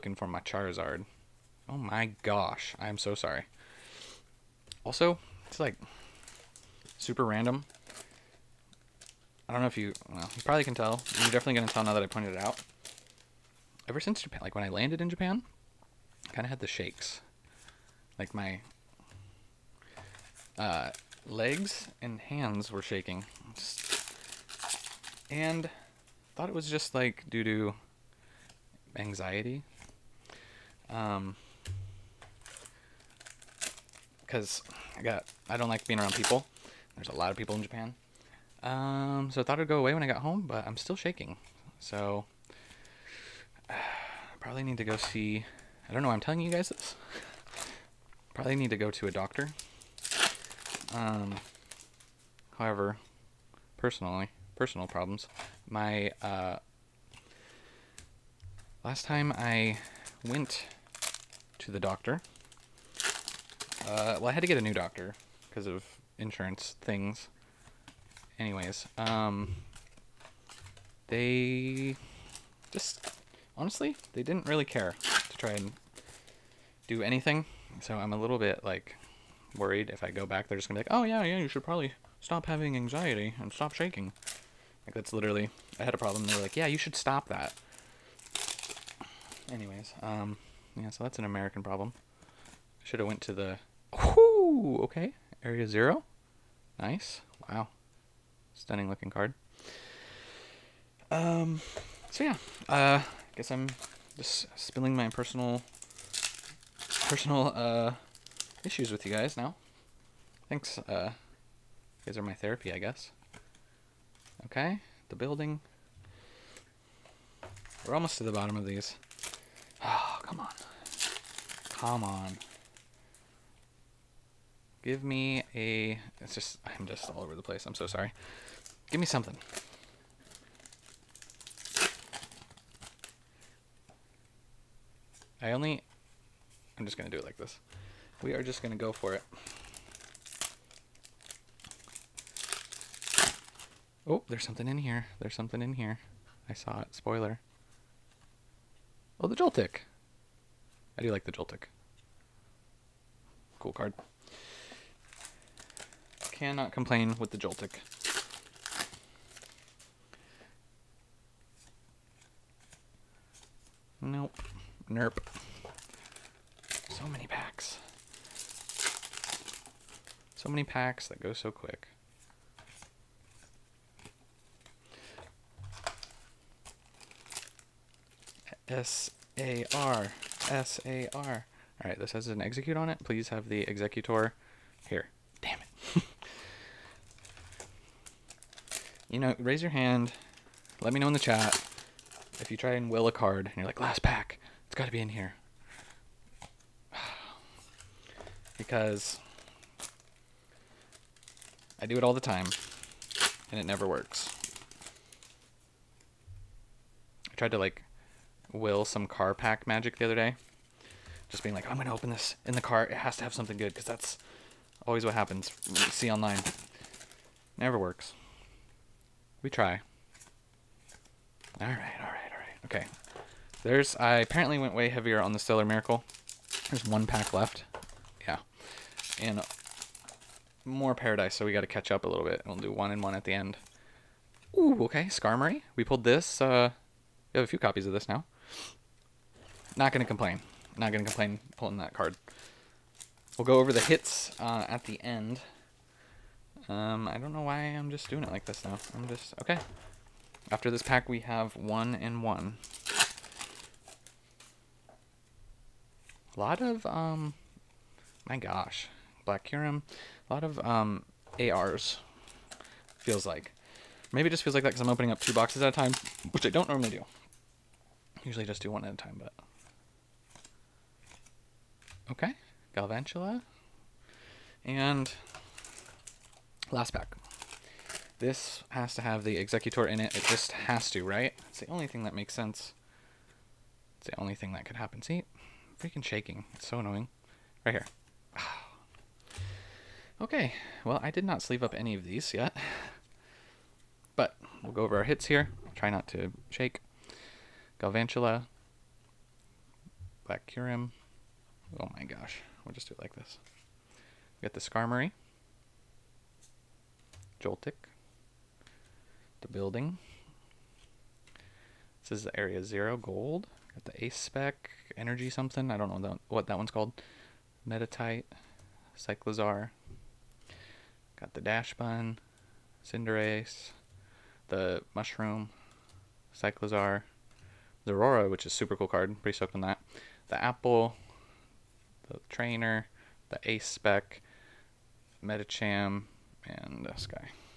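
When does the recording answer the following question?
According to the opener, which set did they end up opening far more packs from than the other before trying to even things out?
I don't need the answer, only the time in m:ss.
3:45.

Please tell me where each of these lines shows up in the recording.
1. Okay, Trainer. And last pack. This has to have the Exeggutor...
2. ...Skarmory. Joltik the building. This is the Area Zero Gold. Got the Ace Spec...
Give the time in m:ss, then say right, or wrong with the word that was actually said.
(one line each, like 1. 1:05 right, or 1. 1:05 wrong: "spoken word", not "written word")
1. 4:32 wrong: "Galvantula", not "Trainer"
2. 5:04 right.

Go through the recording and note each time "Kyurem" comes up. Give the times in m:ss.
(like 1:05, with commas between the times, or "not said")
4:19, 5:00.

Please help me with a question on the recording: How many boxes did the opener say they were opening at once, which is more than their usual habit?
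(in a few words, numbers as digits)
2.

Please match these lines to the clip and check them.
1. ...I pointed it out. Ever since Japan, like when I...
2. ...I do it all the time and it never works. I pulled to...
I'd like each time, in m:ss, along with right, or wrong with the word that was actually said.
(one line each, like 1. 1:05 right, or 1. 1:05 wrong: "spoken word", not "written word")
1. 0:12 right
2. 3:21 wrong: "tried", not "pulled".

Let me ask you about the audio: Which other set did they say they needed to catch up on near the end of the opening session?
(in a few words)
Paradise.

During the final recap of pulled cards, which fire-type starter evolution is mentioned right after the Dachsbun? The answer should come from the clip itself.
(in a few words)
Cinderace.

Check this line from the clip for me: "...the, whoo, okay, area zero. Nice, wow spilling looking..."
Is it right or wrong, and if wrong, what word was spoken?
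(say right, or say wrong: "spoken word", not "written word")
wrong: "stunning", not "spilling".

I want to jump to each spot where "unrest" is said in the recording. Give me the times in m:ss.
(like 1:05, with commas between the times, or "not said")
not said.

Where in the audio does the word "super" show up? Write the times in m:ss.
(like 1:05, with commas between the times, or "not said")
0:06, 5:28.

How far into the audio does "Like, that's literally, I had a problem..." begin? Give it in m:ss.
1:24.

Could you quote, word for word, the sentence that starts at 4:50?
Well, I did not sleeve up any of these yet.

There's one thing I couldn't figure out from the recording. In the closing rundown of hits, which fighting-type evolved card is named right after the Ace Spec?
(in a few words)
Medicham.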